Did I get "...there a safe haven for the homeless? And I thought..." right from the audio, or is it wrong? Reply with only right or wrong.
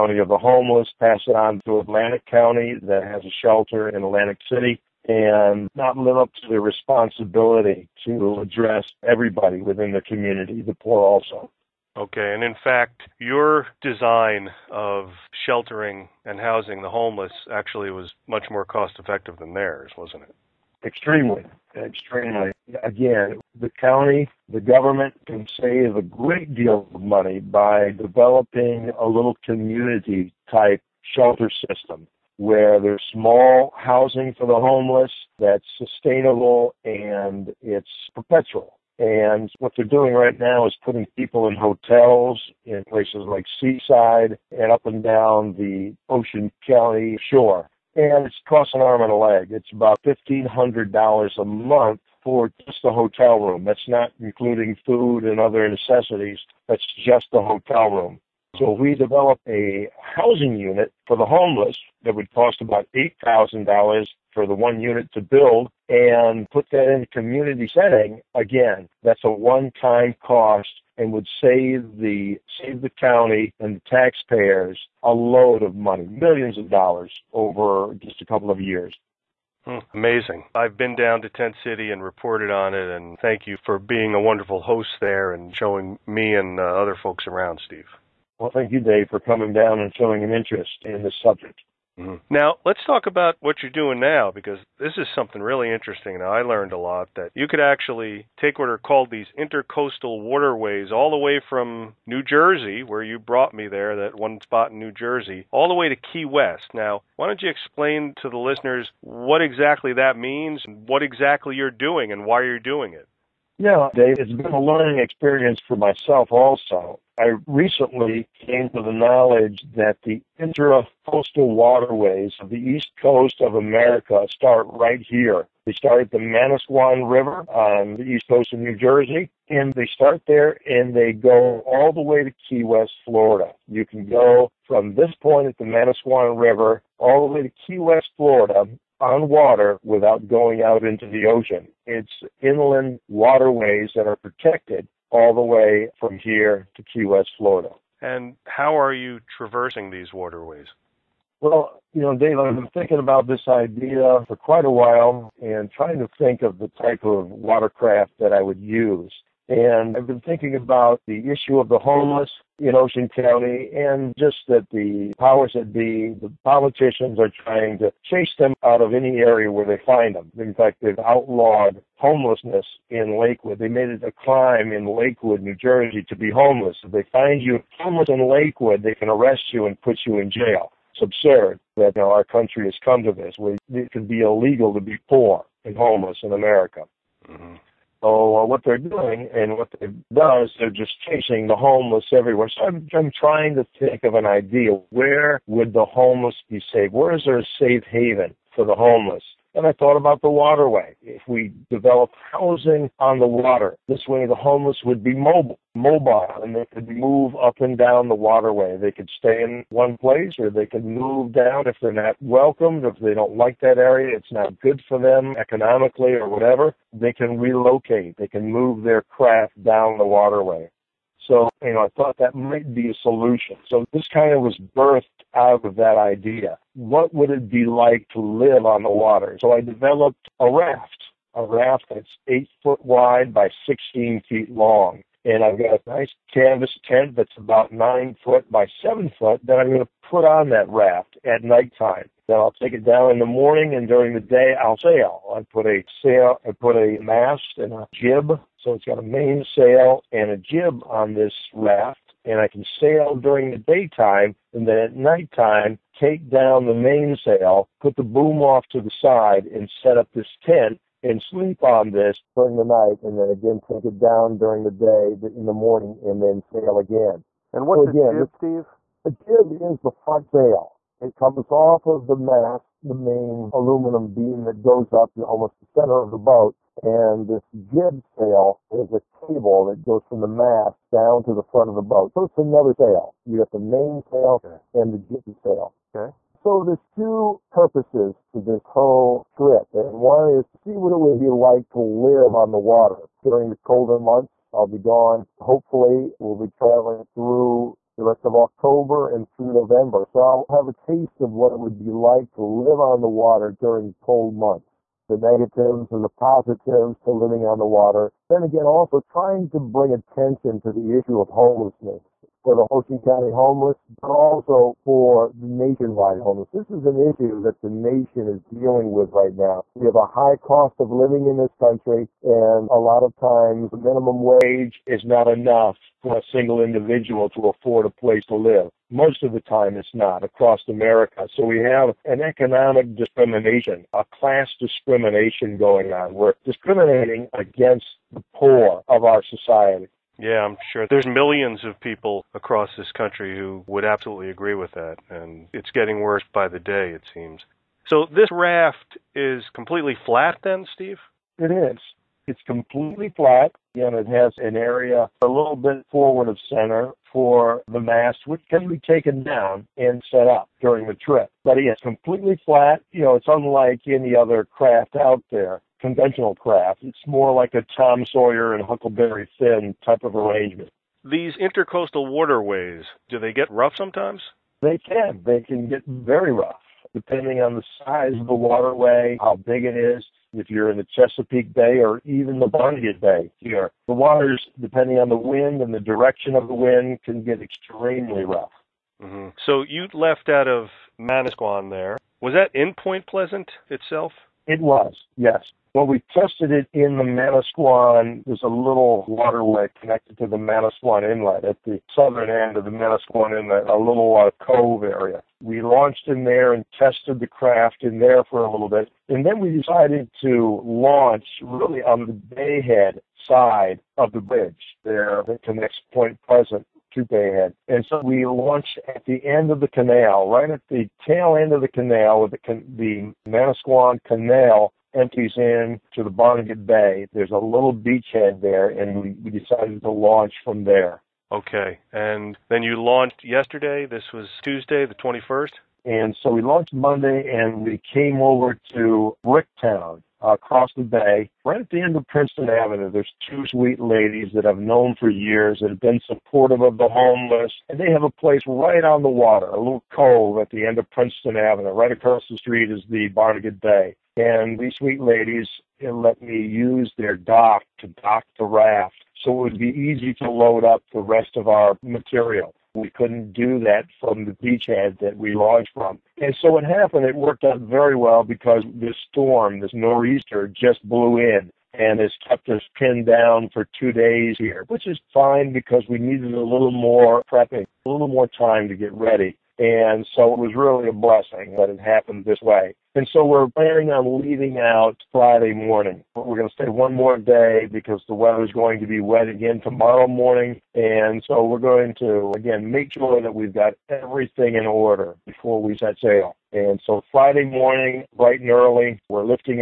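right.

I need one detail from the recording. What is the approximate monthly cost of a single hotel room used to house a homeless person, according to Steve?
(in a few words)
$1,500.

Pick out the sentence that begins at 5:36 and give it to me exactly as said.
We're discriminating against Poor of our society.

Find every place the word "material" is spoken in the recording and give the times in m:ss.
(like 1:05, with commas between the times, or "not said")
7:41.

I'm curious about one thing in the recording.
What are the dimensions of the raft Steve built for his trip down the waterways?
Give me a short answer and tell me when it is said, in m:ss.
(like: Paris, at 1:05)
8 by 16 feet, at 3:52.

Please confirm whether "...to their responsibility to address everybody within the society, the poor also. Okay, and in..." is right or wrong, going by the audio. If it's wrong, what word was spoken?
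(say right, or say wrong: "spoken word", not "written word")
wrong: "community", not "society".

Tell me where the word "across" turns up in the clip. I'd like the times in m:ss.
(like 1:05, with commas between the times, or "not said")
5:30, 5:42, 7:20, 7:31.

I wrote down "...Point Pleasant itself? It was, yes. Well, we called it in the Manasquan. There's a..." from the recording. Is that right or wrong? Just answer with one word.
wrong.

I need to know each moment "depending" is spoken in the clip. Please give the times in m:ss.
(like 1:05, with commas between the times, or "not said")
6:16, 6:24.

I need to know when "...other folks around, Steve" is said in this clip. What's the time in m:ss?
1:26.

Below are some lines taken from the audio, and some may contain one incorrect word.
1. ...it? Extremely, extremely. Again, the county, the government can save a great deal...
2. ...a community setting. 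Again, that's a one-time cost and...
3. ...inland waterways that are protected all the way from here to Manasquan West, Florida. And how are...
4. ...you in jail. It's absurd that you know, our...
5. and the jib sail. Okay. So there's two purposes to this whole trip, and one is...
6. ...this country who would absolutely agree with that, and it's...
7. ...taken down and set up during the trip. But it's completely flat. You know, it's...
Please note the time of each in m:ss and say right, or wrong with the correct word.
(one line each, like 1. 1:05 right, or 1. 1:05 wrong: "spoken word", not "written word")
1. 0:20 right
2. 1:07 right
3. 2:22 wrong: "Key", not "Manasquan"
4. 3:00 right
5. 4:44 right
6. 5:42 right
7. 5:58 right.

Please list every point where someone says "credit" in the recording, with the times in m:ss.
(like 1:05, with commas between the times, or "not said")
not said.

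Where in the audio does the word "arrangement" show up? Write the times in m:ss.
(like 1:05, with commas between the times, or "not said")
6:10.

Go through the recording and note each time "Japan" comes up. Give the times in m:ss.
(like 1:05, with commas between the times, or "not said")
not said.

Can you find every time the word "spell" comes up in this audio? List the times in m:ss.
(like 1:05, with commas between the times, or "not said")
not said.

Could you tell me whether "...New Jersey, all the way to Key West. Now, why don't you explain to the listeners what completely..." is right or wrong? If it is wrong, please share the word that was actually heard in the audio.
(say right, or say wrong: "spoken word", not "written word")
wrong: "exactly", not "completely".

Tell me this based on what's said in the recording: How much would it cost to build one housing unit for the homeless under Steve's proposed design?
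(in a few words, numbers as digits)
$8,000.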